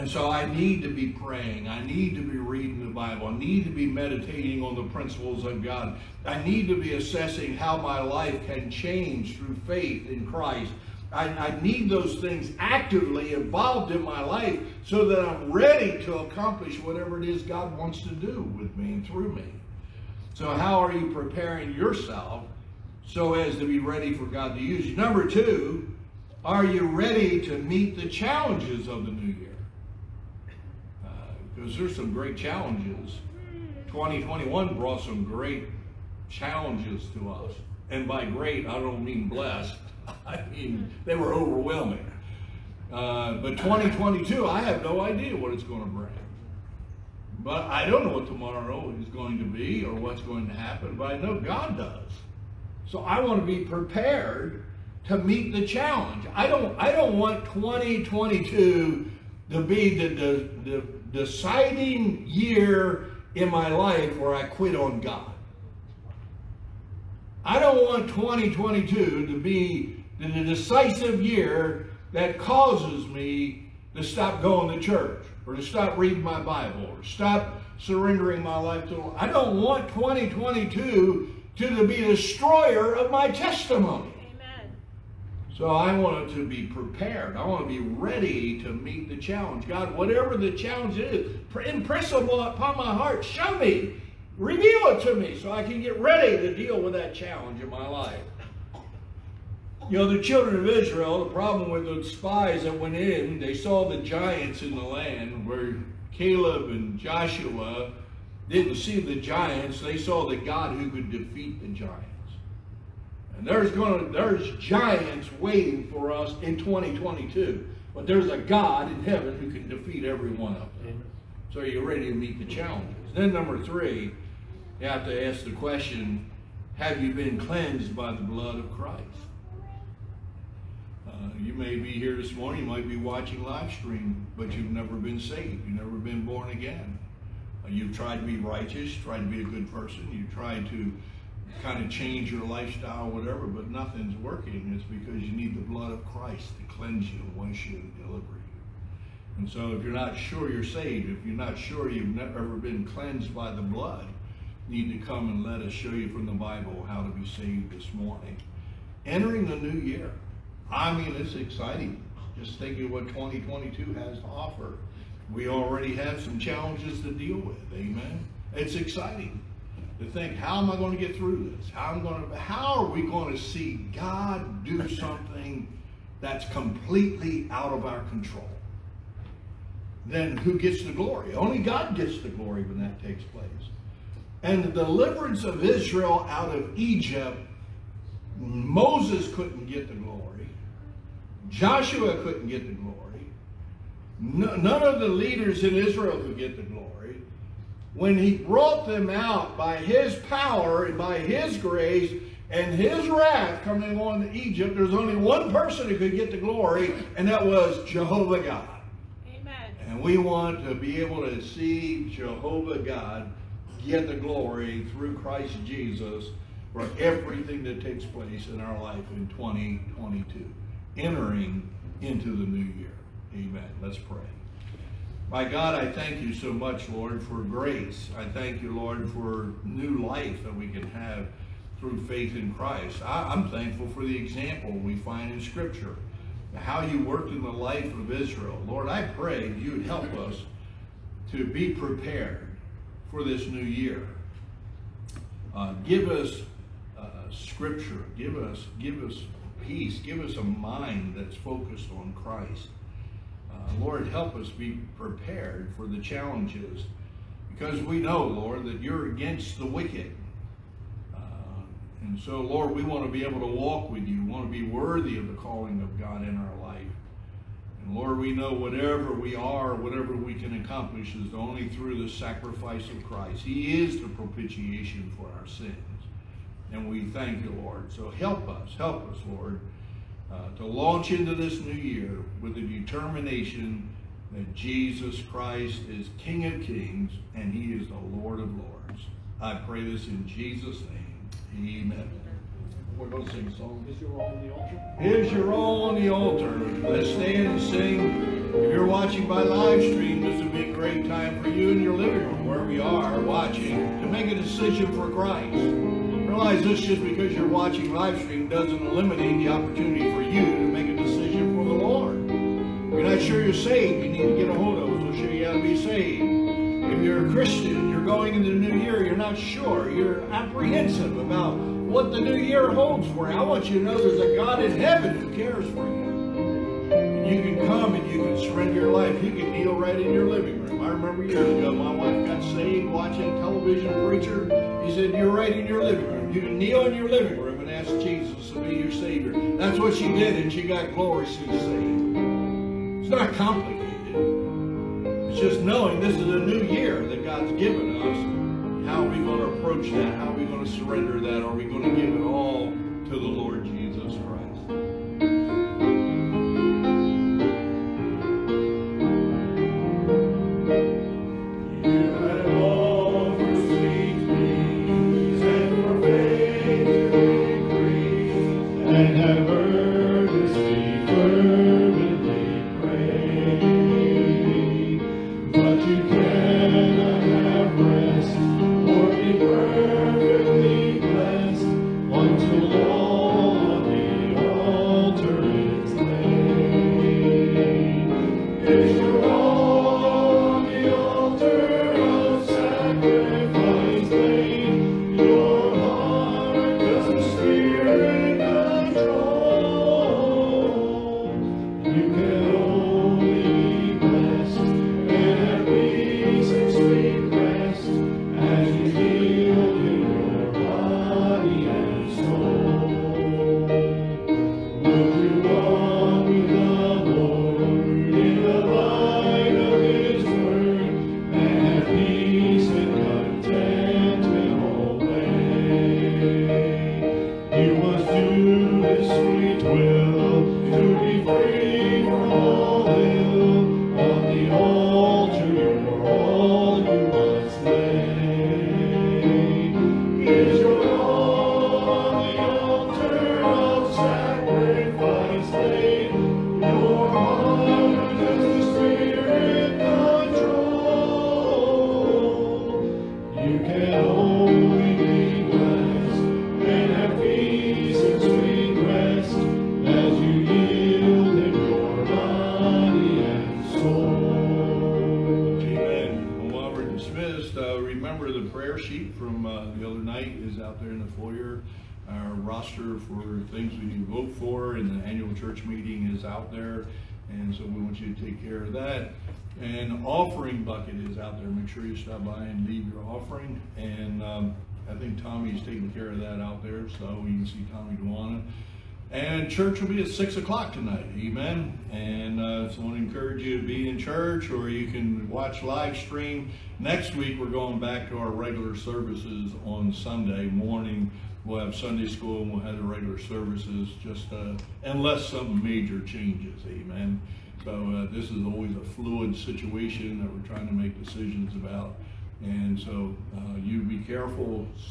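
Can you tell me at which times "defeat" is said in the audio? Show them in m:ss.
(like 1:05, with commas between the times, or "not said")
1:51, 1:59.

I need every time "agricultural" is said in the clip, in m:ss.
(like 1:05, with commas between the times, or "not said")
not said.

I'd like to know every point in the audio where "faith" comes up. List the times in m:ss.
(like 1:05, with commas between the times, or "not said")
0:09, 3:52.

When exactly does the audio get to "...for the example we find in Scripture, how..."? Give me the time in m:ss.
3:53.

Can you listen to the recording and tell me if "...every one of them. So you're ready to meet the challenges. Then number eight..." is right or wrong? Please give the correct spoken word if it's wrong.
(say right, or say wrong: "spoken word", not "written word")
wrong: "three", not "eight".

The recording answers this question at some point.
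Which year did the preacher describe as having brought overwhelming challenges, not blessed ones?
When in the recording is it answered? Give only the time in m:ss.
0:33.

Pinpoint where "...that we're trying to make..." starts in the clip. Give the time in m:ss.
8:30.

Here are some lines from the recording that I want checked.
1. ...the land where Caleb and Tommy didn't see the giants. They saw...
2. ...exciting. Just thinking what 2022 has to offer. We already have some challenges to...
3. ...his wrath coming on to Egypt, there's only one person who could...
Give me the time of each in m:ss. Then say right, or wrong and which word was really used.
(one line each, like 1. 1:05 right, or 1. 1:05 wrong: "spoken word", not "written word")
1. 1:44 wrong: "Joshua", not "Tommy"
2. 2:41 right
3. 3:22 right.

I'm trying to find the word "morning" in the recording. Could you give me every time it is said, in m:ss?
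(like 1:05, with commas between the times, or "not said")
2:12, 2:37, 8:20.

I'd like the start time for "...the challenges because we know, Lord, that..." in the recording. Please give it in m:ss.
4:15.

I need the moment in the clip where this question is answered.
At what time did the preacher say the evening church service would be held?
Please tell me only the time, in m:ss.
8:10.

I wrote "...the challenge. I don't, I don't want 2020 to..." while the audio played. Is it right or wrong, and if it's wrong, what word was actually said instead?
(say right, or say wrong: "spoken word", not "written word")
wrong: "2022", not "2020".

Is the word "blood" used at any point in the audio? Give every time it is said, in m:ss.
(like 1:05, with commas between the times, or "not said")
2:08, 2:25, 2:33.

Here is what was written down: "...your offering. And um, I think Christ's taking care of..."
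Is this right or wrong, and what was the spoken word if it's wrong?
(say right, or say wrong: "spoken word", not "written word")
wrong: "Tommy", not "Christ".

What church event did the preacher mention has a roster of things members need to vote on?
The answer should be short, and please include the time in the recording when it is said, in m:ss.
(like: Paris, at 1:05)
annual church meeting, at 7:55.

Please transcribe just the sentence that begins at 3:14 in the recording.
No, none of the leaders in Israel could get the glory.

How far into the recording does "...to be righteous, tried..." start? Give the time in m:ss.
2:18.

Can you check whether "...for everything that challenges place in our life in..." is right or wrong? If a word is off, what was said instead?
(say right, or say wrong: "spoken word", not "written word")
wrong: "takes", not "challenges".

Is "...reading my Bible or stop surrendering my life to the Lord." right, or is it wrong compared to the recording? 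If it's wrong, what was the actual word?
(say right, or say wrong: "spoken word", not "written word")
right.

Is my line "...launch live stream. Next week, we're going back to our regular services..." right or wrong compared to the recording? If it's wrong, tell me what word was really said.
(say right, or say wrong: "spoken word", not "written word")
wrong: "watch", not "launch".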